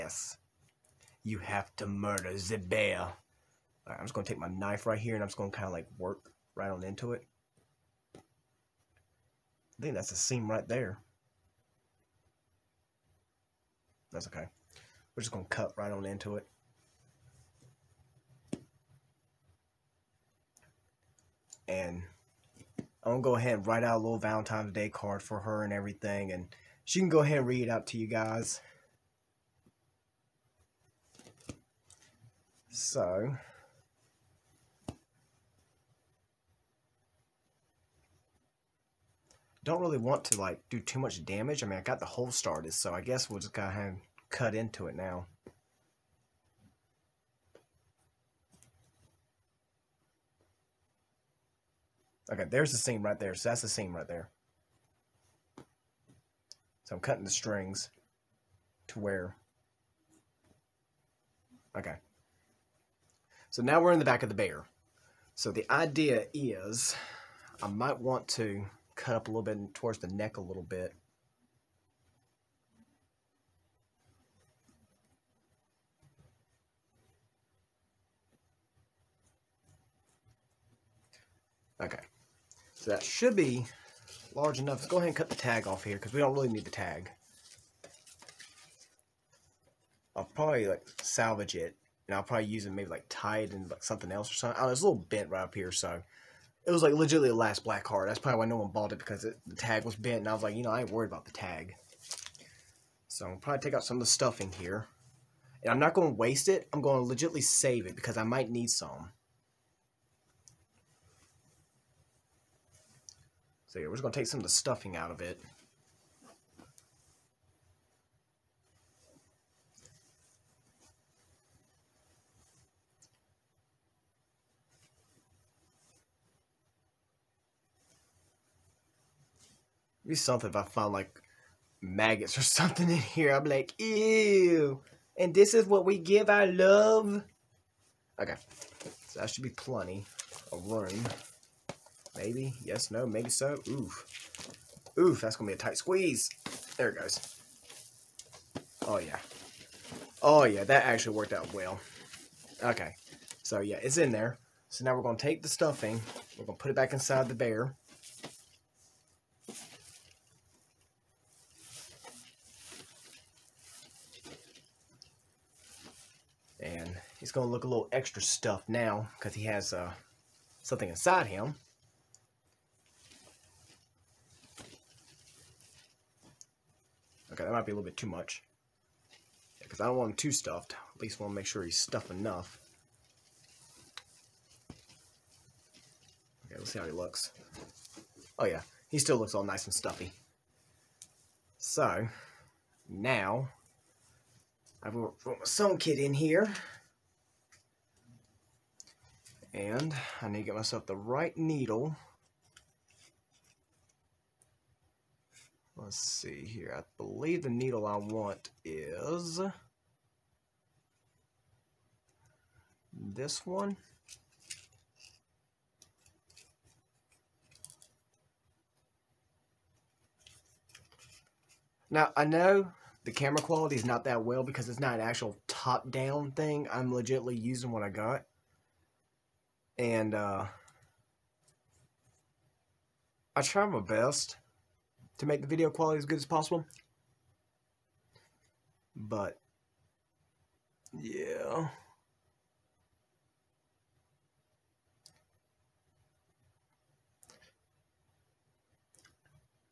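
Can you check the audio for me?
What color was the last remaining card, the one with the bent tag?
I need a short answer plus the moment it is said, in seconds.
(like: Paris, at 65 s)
black, at 97 s.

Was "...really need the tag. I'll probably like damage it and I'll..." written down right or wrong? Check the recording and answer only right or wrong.
wrong.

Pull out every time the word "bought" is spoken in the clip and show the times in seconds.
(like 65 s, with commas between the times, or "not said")
98 s.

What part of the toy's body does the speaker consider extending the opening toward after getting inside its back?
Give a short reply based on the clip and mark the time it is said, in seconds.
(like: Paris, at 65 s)
neck, at 70 s.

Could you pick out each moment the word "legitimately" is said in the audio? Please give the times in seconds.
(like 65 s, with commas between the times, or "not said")
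96 s, 107 s, 226 s.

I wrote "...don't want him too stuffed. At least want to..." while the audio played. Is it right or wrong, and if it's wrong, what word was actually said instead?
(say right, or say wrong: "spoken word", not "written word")
right.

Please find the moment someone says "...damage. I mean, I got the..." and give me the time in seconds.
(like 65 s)
41 s.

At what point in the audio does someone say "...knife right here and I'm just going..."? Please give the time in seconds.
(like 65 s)
4 s.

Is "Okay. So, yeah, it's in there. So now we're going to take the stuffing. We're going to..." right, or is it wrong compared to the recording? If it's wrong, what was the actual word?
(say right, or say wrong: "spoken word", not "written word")
right.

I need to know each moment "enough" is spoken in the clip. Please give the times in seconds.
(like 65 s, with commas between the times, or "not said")
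84 s, 182 s.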